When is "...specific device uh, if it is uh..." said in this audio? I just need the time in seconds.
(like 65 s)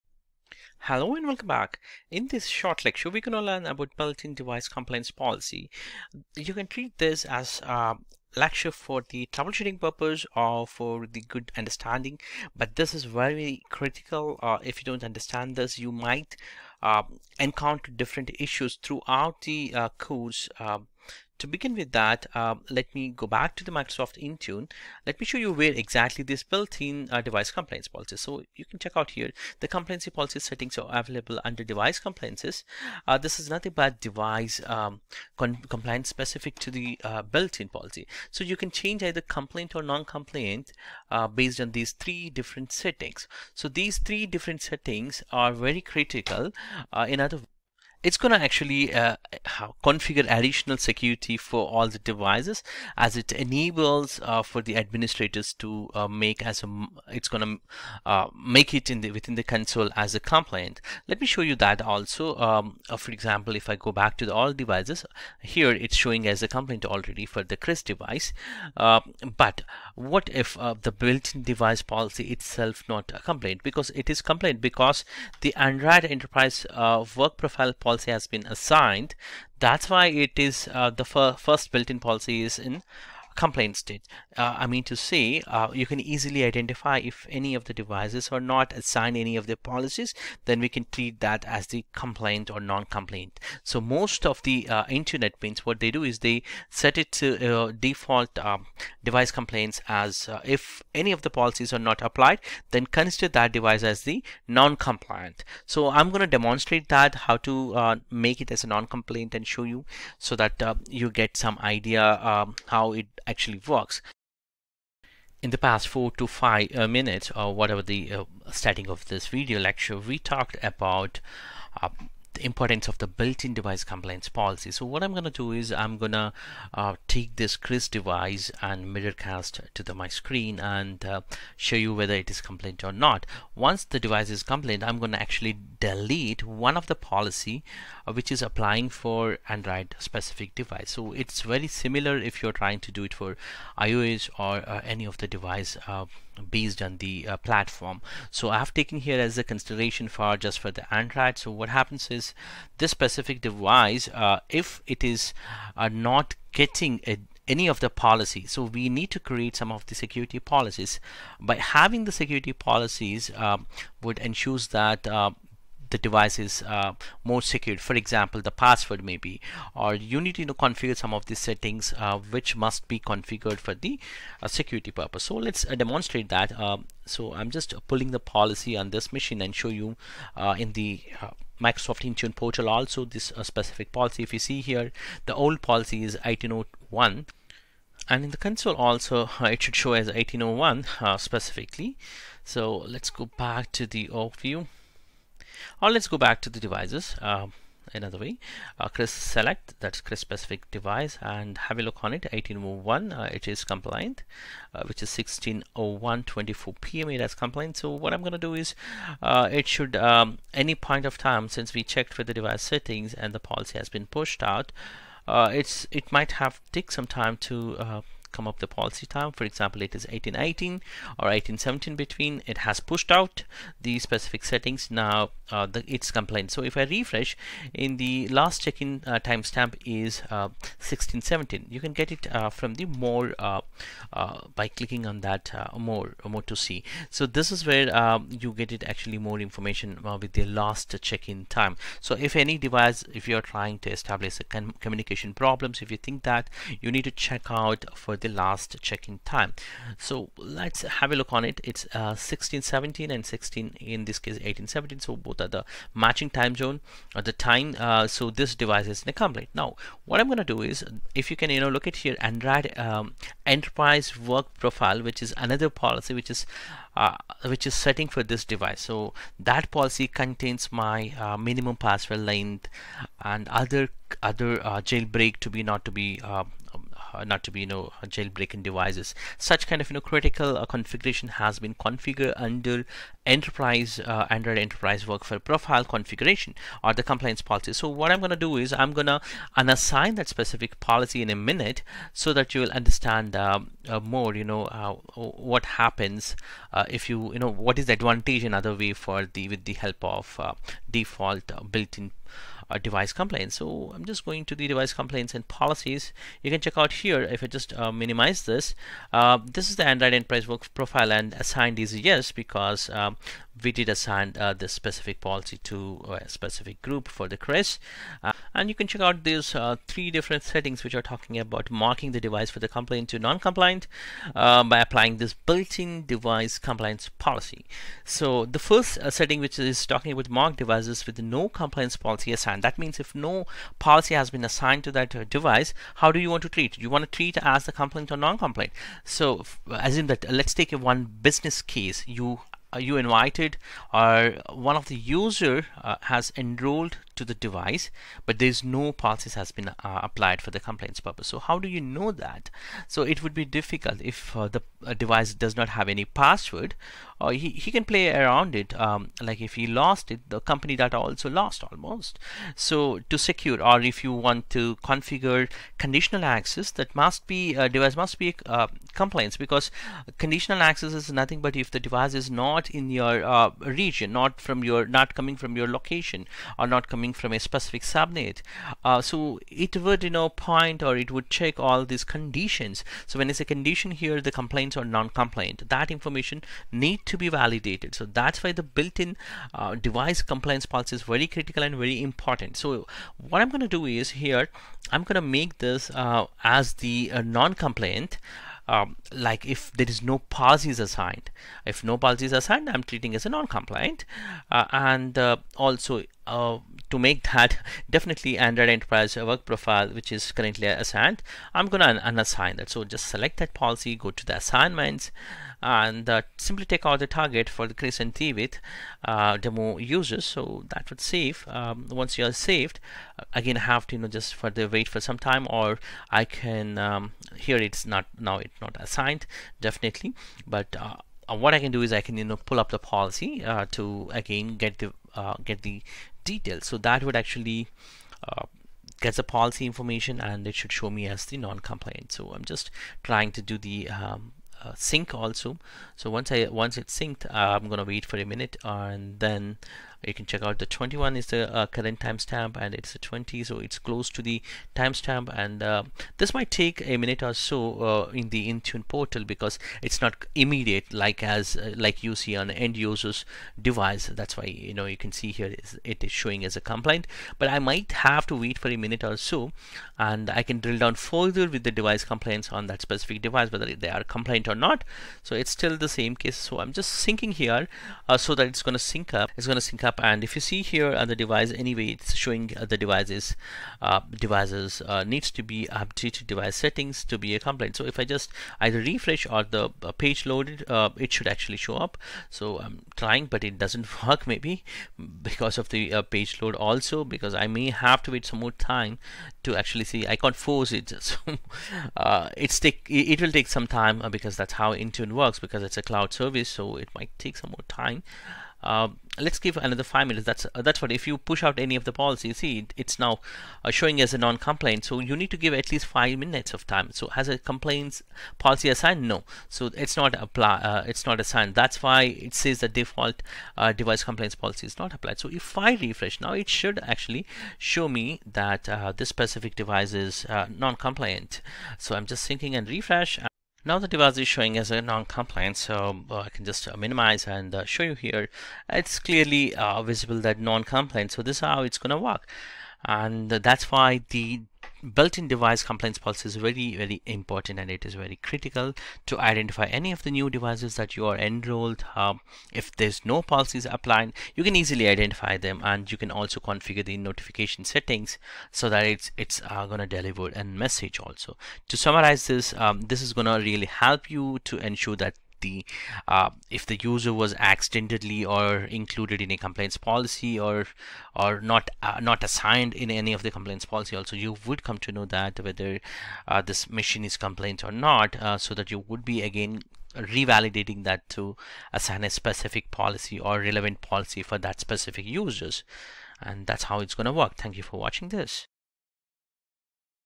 152 s.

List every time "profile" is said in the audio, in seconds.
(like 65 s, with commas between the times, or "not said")
77 s, 264 s, 285 s, 310 s, 409 s.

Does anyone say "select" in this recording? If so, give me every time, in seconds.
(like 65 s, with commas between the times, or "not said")
199 s, 413 s.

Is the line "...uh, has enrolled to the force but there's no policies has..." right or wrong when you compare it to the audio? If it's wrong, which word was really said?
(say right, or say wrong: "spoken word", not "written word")
wrong: "device", not "force".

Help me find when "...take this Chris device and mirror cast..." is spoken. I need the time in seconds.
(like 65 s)
127 s.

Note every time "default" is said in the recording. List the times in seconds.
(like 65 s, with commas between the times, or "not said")
97 s, 300 s, 522 s.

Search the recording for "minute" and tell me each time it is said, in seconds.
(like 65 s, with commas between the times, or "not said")
116 s, 291 s, 448 s, 456 s, 468 s, 510 s, 516 s.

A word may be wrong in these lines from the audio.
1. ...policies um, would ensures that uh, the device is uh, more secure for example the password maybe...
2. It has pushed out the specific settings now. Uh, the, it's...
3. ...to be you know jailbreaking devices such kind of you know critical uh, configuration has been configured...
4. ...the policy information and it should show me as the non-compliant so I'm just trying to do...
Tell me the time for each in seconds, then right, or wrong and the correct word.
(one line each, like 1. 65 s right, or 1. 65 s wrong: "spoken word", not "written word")
1. 162 s right
2. 222 s right
3. 277 s right
4. 439 s right.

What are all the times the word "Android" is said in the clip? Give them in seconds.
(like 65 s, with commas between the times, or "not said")
75 s, 139 s, 150 s, 262 s, 284 s, 309 s, 408 s.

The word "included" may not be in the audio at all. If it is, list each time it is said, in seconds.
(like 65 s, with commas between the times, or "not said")
568 s.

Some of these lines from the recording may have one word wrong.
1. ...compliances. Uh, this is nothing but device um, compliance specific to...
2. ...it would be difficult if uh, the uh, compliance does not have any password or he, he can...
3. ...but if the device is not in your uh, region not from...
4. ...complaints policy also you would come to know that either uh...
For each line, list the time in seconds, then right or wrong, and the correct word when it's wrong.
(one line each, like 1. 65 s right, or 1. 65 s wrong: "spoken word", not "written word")
1. 31 s right
2. 353 s wrong: "device", not "compliance"
3. 371 s right
4. 573 s wrong: "whether", not "either".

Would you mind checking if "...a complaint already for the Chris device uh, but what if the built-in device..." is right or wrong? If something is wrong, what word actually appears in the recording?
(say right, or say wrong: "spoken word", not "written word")
right.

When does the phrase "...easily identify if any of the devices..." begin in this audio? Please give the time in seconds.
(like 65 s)
85 s.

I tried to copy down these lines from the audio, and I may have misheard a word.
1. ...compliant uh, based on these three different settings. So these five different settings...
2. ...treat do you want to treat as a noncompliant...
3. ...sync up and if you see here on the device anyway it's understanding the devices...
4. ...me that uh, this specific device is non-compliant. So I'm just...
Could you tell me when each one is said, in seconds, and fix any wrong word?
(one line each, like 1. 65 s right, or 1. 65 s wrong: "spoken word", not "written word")
1. 40 s wrong: "three", not "five"
2. 336 s wrong: "complaint", not "noncompliant"
3. 479 s wrong: "showing", not "understanding"
4. 527 s right.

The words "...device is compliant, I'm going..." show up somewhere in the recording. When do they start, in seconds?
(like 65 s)
133 s.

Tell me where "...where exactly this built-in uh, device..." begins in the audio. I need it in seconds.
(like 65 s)
25 s.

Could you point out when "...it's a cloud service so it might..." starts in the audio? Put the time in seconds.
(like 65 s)
505 s.